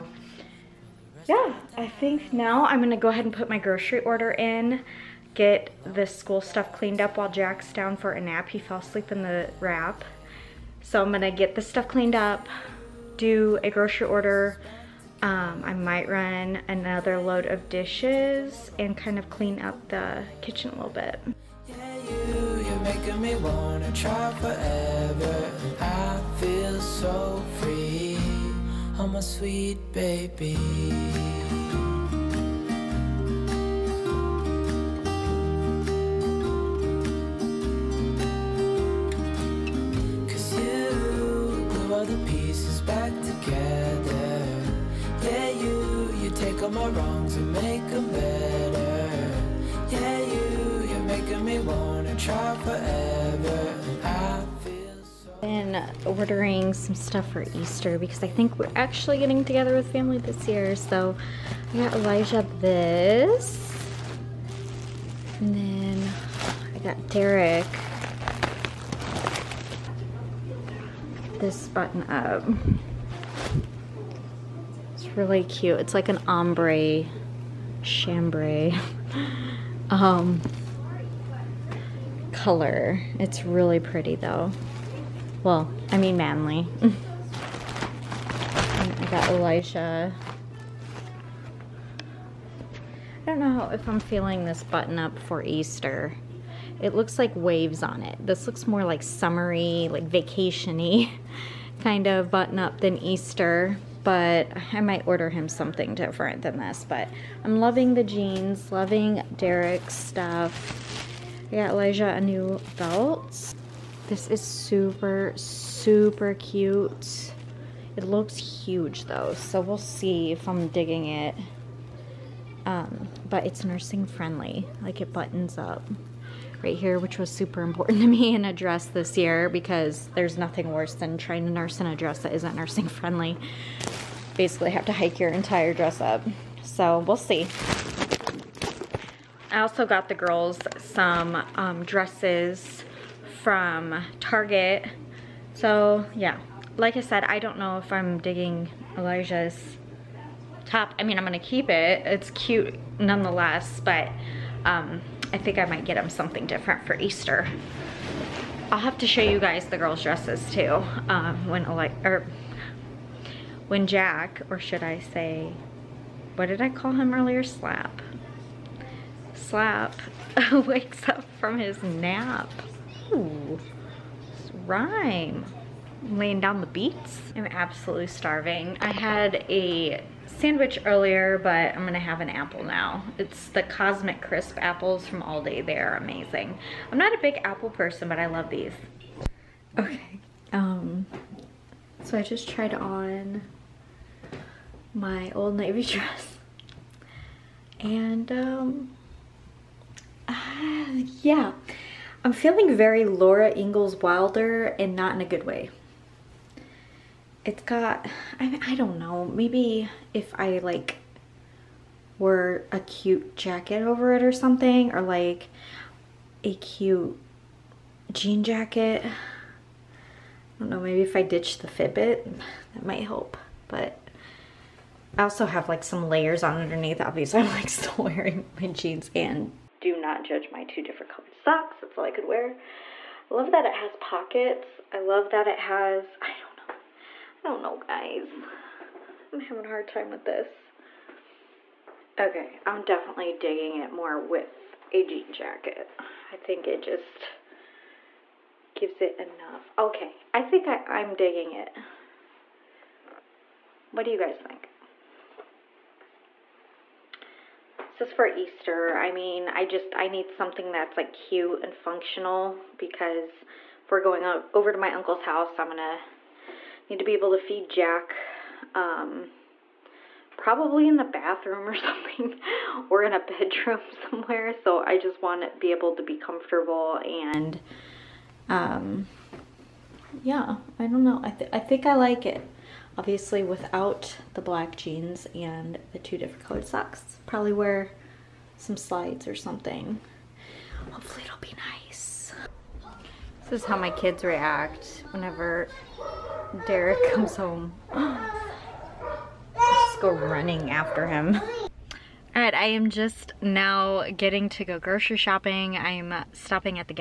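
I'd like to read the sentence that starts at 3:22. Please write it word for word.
I'm feeling very Laura Ingalls Wilder and not in a good way.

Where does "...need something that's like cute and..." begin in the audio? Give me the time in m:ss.
4:20.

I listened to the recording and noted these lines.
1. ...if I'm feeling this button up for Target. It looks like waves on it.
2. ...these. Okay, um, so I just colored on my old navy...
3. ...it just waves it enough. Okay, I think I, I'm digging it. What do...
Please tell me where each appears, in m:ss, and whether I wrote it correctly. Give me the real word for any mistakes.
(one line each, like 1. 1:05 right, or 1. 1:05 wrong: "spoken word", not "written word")
1. 1:33 wrong: "Easter", not "Target"
2. 3:08 wrong: "tried", not "colored"
3. 4:06 wrong: "gives", not "waves".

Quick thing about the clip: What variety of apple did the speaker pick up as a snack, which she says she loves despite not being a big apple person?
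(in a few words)
Cosmic Crisp.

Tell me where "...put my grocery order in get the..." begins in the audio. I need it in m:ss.
0:03.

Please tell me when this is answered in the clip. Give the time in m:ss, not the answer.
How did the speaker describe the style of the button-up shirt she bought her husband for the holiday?
1:16.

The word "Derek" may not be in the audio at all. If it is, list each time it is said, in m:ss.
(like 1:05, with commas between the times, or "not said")
1:07, 1:49, 4:56.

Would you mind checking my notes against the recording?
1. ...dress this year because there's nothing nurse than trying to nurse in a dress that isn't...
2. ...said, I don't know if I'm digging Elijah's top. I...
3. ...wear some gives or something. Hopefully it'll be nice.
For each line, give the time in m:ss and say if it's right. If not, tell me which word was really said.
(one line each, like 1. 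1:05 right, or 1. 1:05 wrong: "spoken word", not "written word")
1. 2:08 wrong: "worse", not "nurse"
2. 2:27 right
3. 4:47 wrong: "slides", not "gives".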